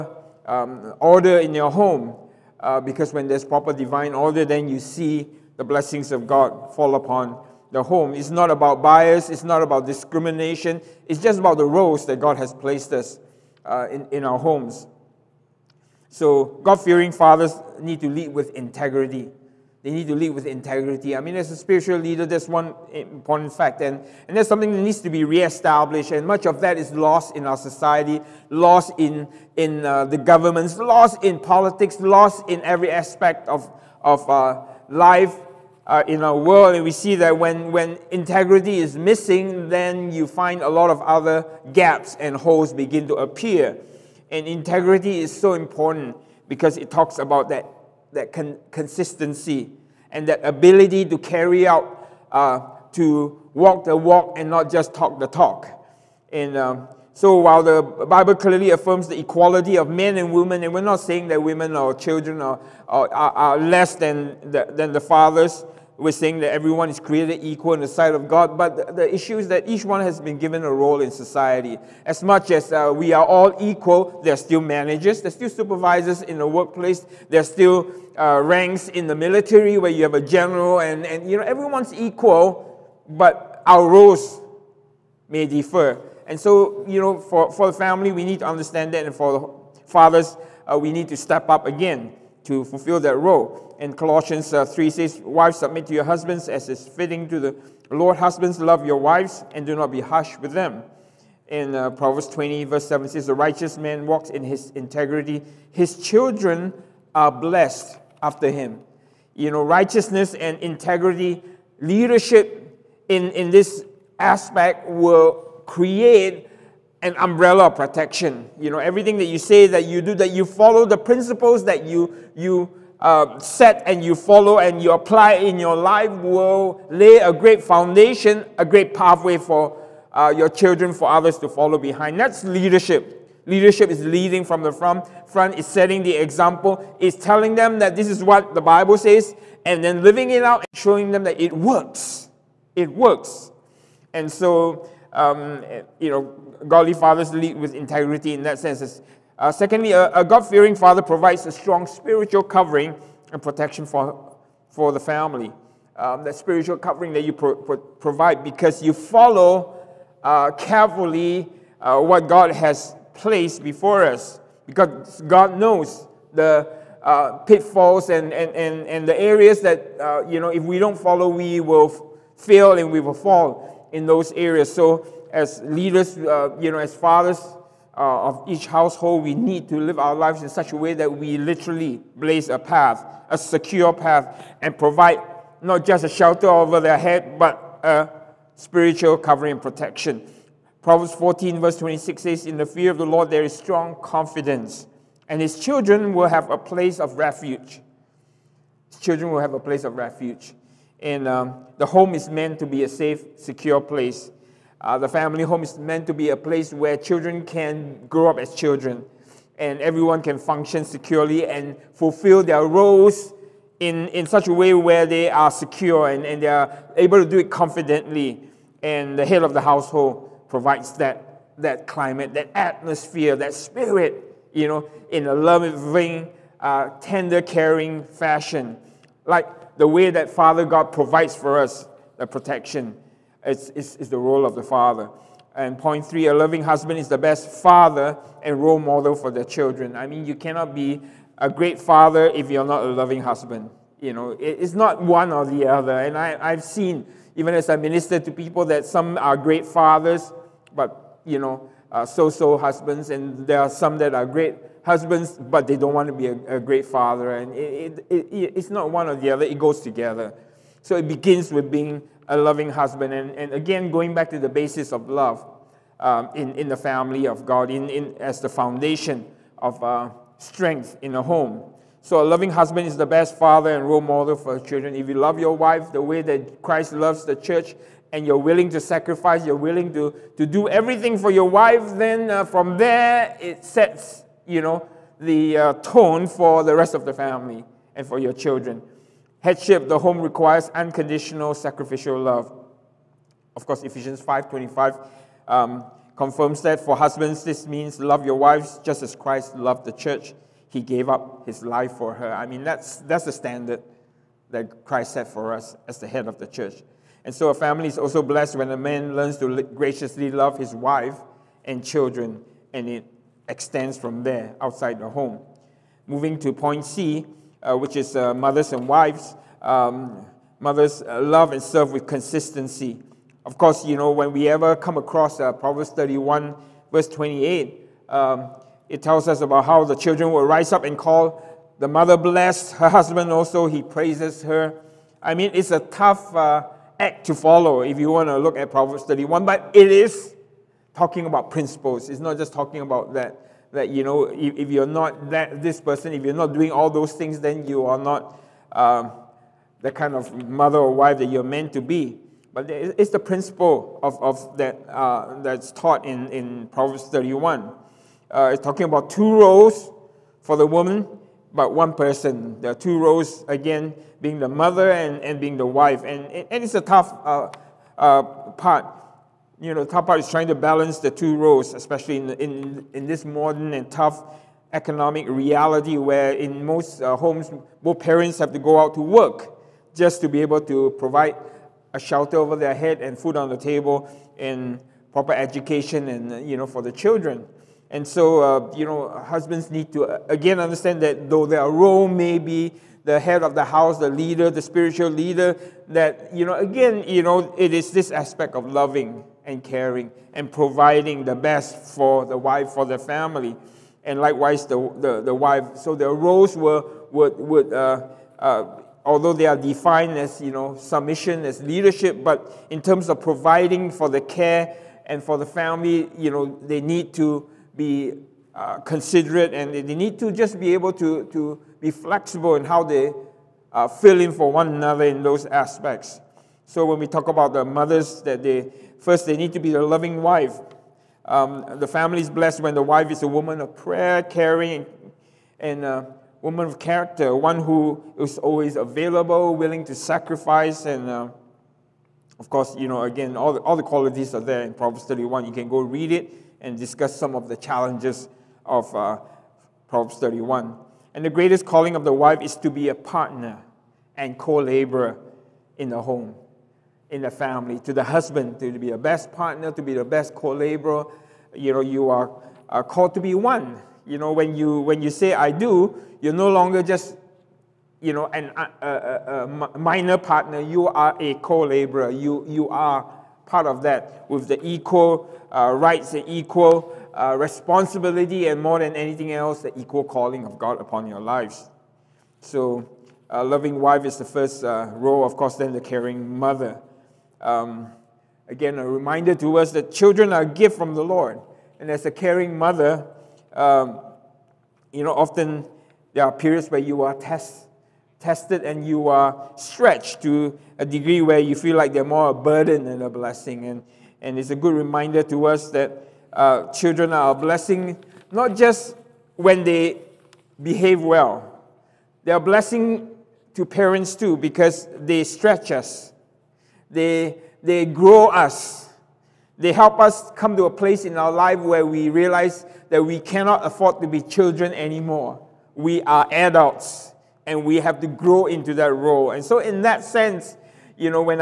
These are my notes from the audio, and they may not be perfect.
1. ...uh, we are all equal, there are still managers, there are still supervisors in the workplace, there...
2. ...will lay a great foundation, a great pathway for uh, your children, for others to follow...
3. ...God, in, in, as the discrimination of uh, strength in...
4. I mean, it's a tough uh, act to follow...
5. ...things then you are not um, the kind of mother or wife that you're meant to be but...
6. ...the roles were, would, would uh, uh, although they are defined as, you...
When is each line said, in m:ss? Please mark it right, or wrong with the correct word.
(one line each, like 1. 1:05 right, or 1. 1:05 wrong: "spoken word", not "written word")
1. 1:12 right
2. 2:06 right
3. 4:27 wrong: "foundation", not "discrimination"
4. 5:35 right
5. 5:47 right
6. 6:45 right.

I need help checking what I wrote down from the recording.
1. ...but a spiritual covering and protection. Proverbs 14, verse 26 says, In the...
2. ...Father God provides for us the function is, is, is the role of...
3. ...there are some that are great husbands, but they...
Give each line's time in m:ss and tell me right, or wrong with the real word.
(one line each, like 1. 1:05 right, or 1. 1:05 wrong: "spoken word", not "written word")
1. 3:07 right
2. 3:50 wrong: "protection", not "function"
3. 4:13 right.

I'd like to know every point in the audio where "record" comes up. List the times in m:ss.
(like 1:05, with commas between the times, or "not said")
not said.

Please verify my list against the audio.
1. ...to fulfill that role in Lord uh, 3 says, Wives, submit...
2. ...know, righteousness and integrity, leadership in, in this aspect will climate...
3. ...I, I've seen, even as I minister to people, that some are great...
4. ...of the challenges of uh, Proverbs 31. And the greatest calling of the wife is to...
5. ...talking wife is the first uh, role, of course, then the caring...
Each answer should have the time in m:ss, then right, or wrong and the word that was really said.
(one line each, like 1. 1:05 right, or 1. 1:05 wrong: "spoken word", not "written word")
1. 1:32 wrong: "Colossians", not "Lord"
2. 1:49 wrong: "create", not "climate"
3. 4:06 right
4. 7:27 right
5. 8:03 wrong: "loving", not "talking".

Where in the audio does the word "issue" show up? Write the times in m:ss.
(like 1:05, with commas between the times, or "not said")
1:09.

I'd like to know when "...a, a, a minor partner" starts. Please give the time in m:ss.
7:48.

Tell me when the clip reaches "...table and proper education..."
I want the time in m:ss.
6:23.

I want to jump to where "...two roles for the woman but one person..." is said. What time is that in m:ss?
5:59.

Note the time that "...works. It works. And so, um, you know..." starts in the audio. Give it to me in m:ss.
2:21.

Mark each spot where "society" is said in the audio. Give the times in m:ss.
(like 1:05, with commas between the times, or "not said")
0:27, 1:11.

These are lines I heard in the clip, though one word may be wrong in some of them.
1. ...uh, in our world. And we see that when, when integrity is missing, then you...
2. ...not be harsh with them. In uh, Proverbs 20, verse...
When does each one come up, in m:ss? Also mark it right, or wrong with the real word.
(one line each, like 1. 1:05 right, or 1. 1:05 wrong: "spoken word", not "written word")
1. 0:35 right
2. 1:39 right.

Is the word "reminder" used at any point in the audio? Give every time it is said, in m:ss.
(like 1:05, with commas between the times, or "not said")
8:08, 8:24.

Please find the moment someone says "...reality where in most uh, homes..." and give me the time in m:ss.
6:15.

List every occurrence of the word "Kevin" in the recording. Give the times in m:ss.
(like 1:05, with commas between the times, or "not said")
not said.